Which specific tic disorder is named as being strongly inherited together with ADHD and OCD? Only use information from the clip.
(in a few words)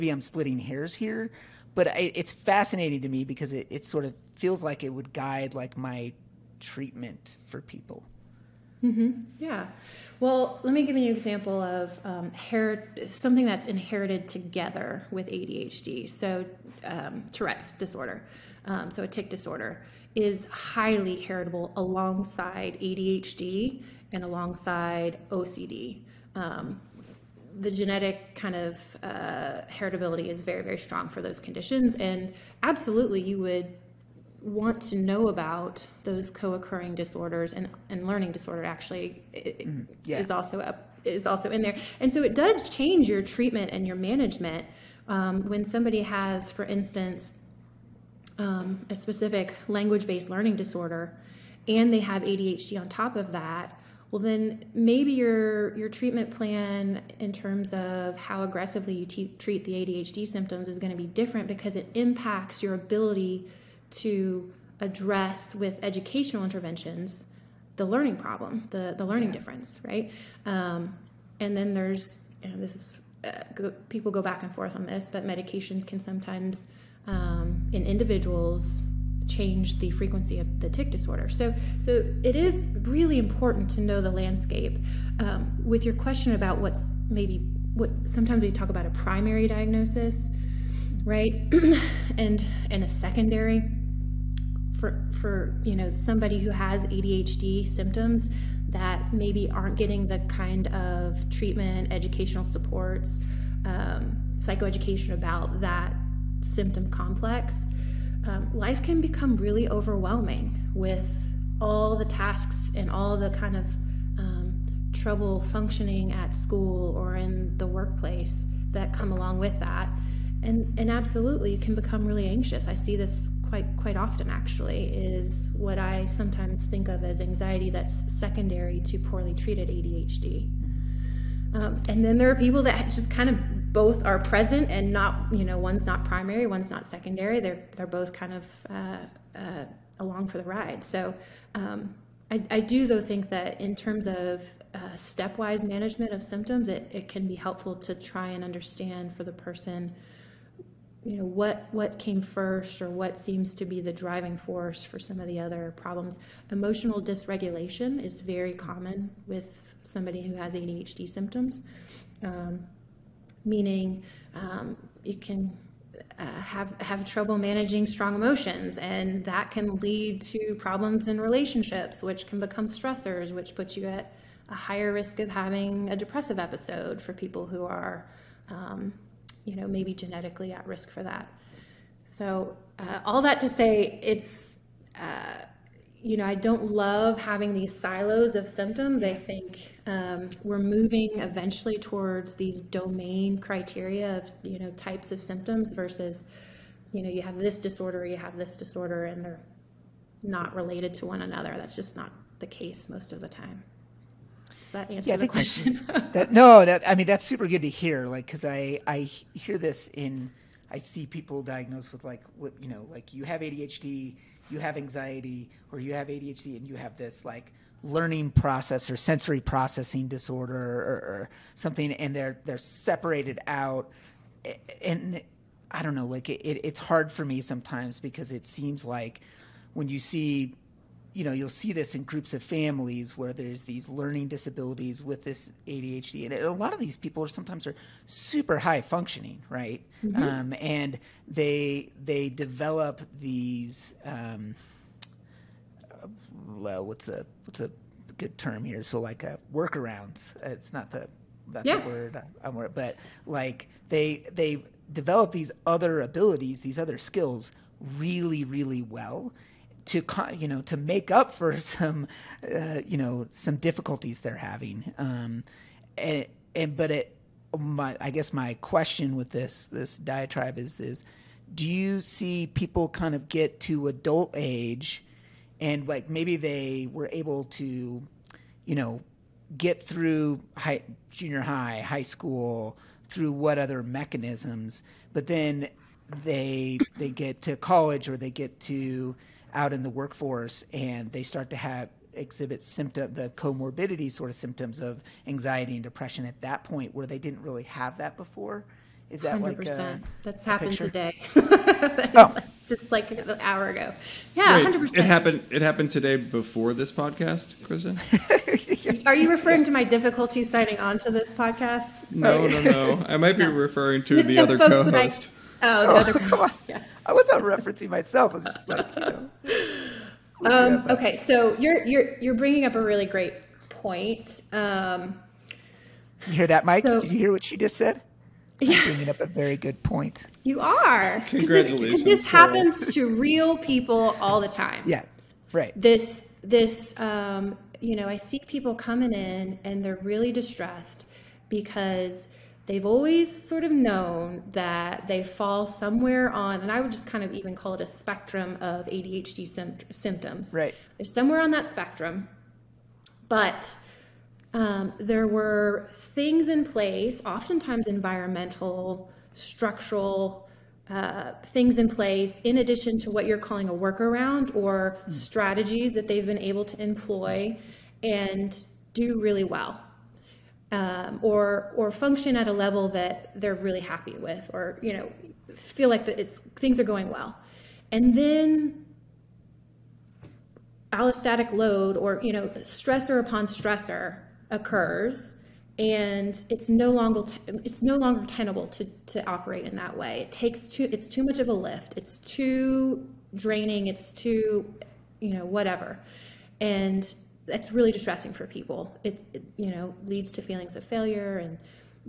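Tourette's disorder.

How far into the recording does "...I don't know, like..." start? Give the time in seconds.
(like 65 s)
225 s.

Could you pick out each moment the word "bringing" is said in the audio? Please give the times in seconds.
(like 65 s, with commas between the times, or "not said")
322 s, 328 s.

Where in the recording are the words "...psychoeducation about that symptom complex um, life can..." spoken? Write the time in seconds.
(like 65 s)
104 s.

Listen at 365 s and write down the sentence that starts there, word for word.
strategies that they've been able to employ and do really well.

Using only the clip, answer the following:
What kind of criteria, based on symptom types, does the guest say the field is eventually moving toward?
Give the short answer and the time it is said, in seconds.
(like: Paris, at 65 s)
domain criteria, at 192 s.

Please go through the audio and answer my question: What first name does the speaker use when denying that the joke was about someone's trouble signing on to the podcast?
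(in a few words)
Kristin.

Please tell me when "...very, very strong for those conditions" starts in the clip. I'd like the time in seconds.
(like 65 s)
30 s.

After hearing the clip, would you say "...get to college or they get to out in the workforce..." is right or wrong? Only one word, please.
right.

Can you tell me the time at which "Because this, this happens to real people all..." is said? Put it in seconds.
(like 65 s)
331 s.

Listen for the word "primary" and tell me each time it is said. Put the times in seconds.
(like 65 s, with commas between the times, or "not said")
88 s, 136 s.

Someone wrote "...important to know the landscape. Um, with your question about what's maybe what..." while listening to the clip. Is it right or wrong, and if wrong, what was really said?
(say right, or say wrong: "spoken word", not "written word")
right.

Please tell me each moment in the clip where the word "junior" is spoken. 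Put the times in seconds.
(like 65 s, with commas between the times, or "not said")
281 s.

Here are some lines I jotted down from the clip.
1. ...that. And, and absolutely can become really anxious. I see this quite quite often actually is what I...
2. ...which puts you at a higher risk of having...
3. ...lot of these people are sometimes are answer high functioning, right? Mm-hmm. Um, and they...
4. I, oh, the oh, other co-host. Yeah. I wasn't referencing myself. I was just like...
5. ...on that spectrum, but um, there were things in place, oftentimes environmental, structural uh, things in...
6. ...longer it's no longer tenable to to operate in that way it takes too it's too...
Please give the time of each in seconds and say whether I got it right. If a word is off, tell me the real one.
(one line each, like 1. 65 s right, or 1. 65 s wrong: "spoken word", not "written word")
1. 119 s right
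2. 173 s right
3. 236 s wrong: "super", not "answer"
4. 315 s right
5. 351 s right
6. 386 s right.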